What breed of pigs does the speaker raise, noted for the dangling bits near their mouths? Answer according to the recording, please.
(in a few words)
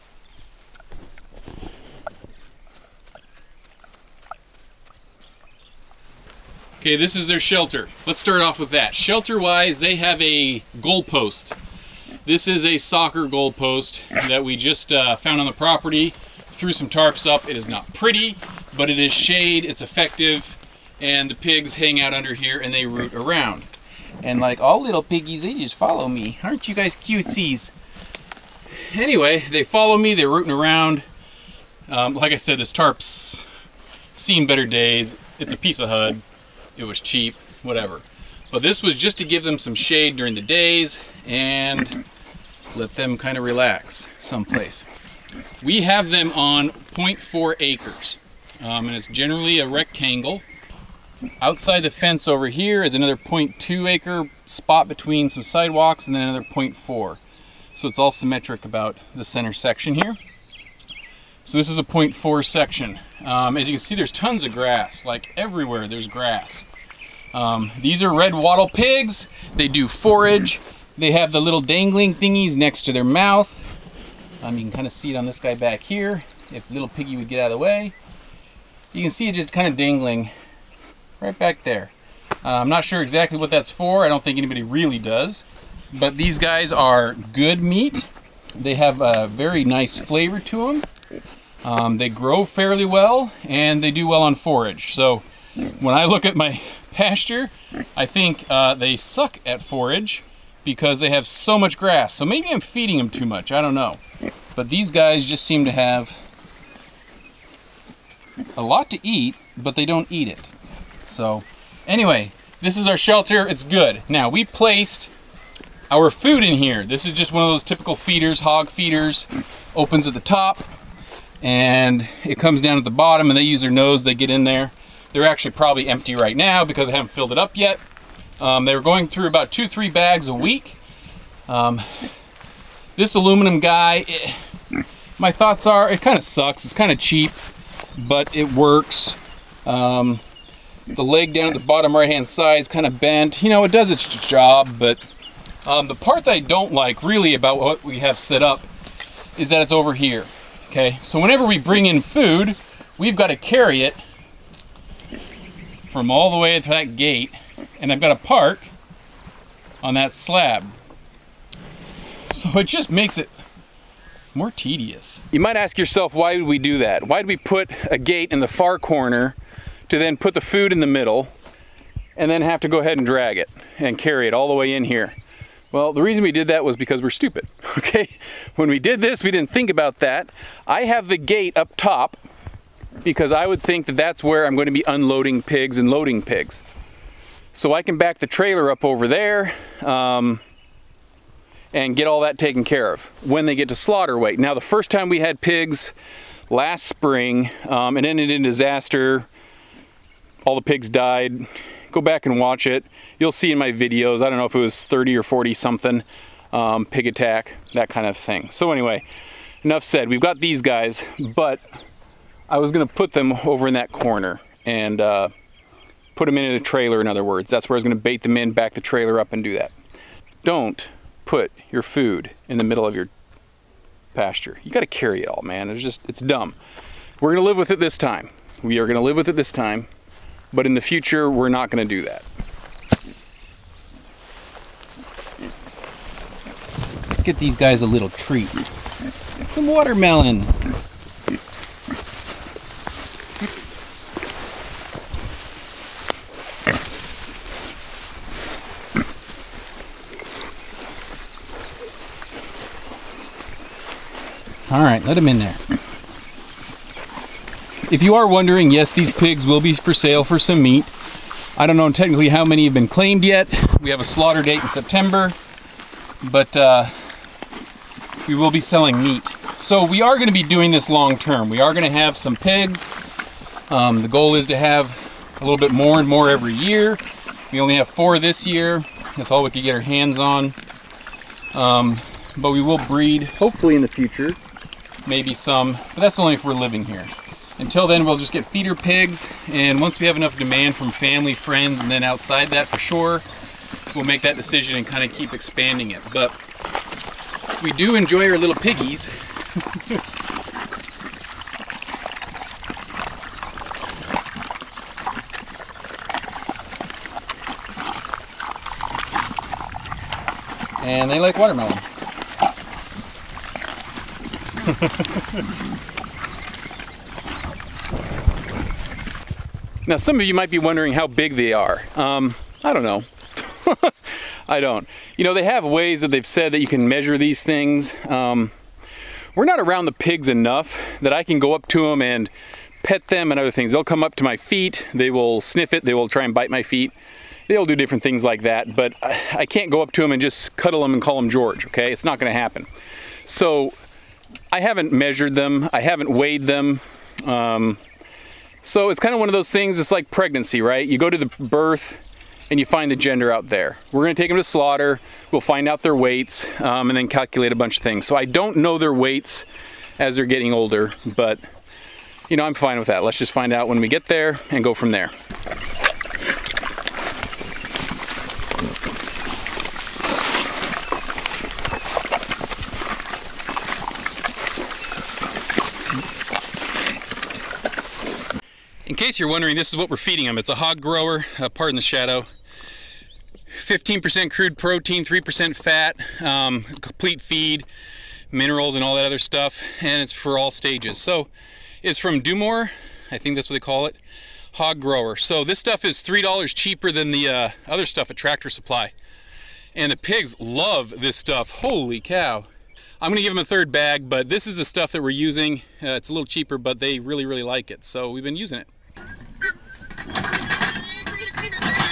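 Red wattle.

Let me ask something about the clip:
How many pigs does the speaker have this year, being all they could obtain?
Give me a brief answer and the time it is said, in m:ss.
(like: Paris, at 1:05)
4, at 4:37.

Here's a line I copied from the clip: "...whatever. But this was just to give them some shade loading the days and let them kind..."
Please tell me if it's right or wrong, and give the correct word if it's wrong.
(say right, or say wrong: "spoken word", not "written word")
wrong: "during", not "loading".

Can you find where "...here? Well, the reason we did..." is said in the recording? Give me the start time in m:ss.
2:54.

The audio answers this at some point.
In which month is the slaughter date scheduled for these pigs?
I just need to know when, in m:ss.
4:24.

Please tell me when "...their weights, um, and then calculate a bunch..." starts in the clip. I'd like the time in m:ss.
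5:55.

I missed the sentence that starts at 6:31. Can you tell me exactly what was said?
So it's from DuMOR, I think that's what they call it, hog grower.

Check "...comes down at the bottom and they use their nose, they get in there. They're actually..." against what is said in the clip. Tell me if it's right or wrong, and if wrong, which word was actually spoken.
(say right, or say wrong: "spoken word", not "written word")
right.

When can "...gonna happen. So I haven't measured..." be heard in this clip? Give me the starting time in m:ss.
5:42.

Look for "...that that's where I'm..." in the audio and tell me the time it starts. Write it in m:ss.
3:03.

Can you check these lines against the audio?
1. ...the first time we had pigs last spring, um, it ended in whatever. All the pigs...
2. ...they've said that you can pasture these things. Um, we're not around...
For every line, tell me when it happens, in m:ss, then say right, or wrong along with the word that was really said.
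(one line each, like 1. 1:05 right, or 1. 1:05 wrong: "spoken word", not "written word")
1. 3:14 wrong: "disaster", not "whatever"
2. 5:26 wrong: "measure", not "pasture".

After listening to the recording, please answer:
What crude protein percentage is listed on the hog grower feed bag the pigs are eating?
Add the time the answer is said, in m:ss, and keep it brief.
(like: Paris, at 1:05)
15%, at 6:23.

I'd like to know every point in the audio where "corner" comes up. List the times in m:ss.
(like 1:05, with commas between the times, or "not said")
2:48, 3:33.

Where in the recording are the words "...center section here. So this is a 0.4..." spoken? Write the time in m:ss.
0:59.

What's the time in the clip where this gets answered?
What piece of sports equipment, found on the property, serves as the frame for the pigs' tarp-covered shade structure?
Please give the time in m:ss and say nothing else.
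0:12.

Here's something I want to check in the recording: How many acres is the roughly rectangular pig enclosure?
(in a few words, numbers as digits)
0.4.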